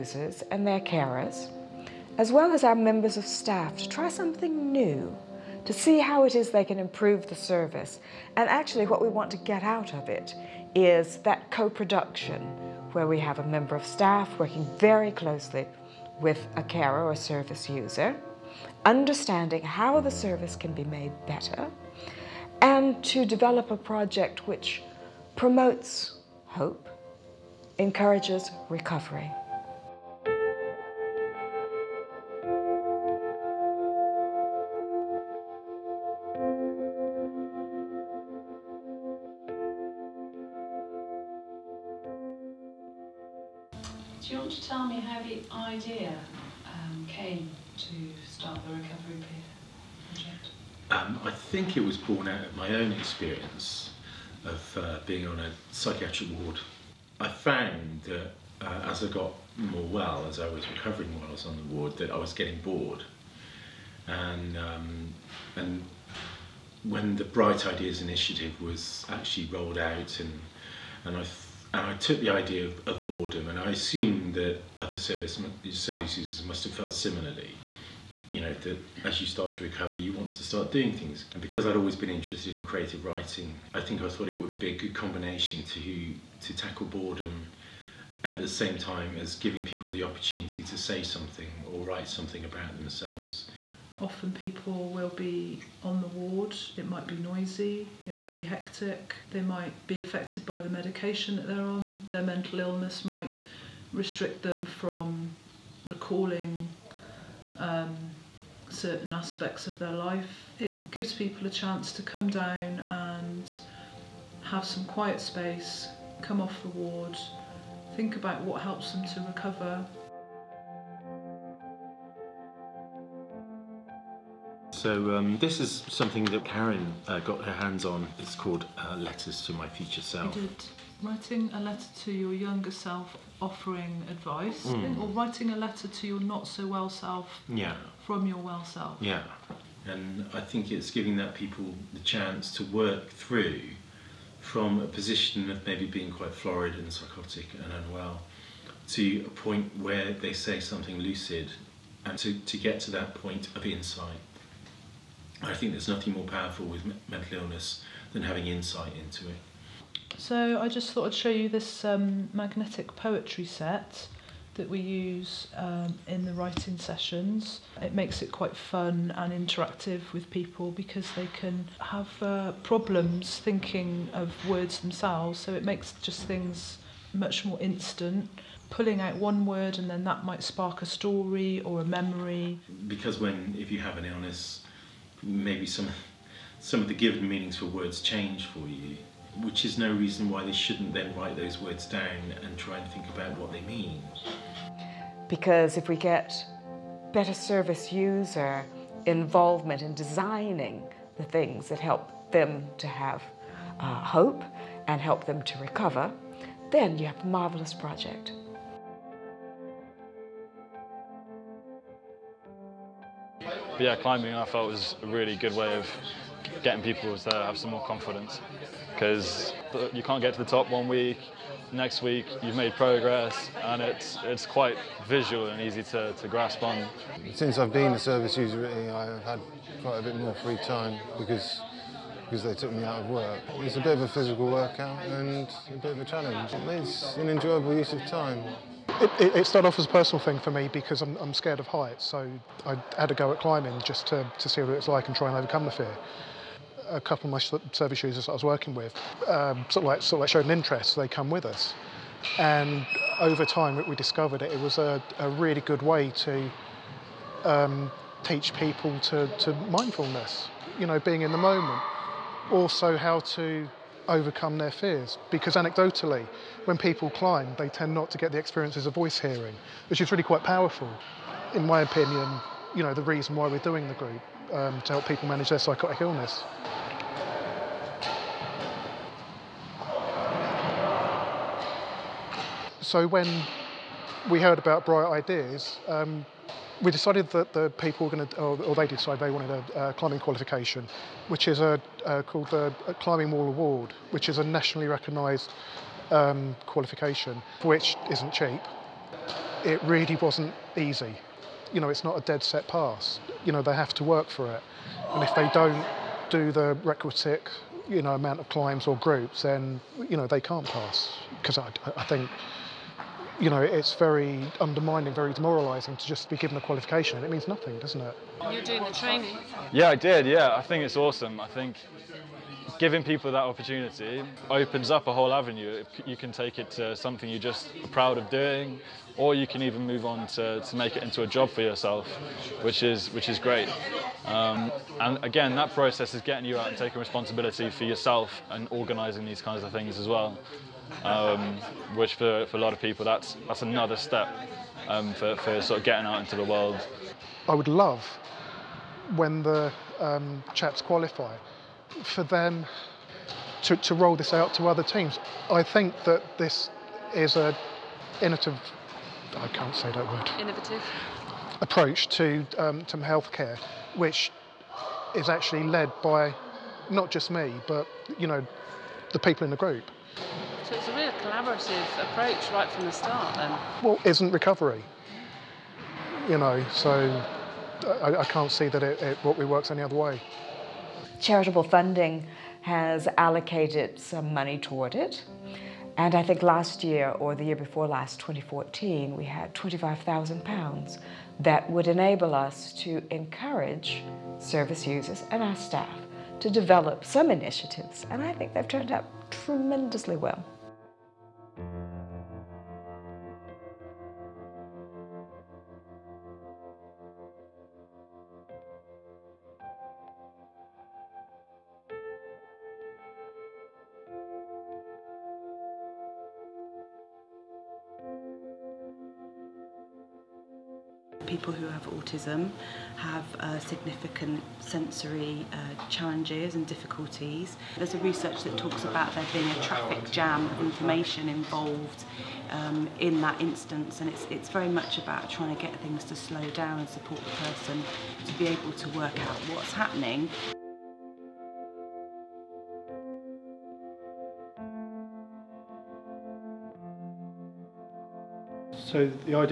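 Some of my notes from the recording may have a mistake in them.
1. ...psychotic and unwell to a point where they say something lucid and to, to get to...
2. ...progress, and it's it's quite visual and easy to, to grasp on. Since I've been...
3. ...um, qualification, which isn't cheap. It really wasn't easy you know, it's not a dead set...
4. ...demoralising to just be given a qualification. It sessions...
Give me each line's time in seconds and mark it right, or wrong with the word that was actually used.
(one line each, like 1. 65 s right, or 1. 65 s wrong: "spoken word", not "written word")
1. 146 s right
2. 222 s right
3. 296 s right
4. 315 s wrong: "means", not "sessions".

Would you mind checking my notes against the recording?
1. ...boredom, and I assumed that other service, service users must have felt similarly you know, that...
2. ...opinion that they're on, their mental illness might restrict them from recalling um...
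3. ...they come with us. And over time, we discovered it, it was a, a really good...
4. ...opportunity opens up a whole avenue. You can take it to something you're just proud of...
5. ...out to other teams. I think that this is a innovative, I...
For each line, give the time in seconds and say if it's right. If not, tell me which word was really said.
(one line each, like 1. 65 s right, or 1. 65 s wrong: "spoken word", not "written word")
1. 73 s right
2. 100 s wrong: "medication", not "opinion"
3. 250 s right
4. 323 s right
5. 354 s right.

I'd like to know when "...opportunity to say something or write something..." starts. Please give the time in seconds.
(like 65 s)
90 s.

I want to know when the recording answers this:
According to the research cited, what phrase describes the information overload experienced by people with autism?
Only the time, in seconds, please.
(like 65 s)
429 s.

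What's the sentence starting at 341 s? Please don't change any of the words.
Um, which for, for a lot of people, that's that's another step um, for, for sort of getting out into the world.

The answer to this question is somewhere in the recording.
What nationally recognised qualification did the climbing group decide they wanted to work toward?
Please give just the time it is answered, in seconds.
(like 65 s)
292 s.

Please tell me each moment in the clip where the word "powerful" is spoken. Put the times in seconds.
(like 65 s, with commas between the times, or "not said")
156 s, 270 s.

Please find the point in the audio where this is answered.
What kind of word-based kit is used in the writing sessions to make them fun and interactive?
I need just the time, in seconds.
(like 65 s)
162 s.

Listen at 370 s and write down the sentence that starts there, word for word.
So it's a real collaborative approach right from the start then?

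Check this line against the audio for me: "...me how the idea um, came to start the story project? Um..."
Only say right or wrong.
wrong.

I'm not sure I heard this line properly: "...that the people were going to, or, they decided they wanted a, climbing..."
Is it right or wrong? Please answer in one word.
right.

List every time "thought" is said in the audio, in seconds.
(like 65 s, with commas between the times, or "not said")
84 s, 160 s.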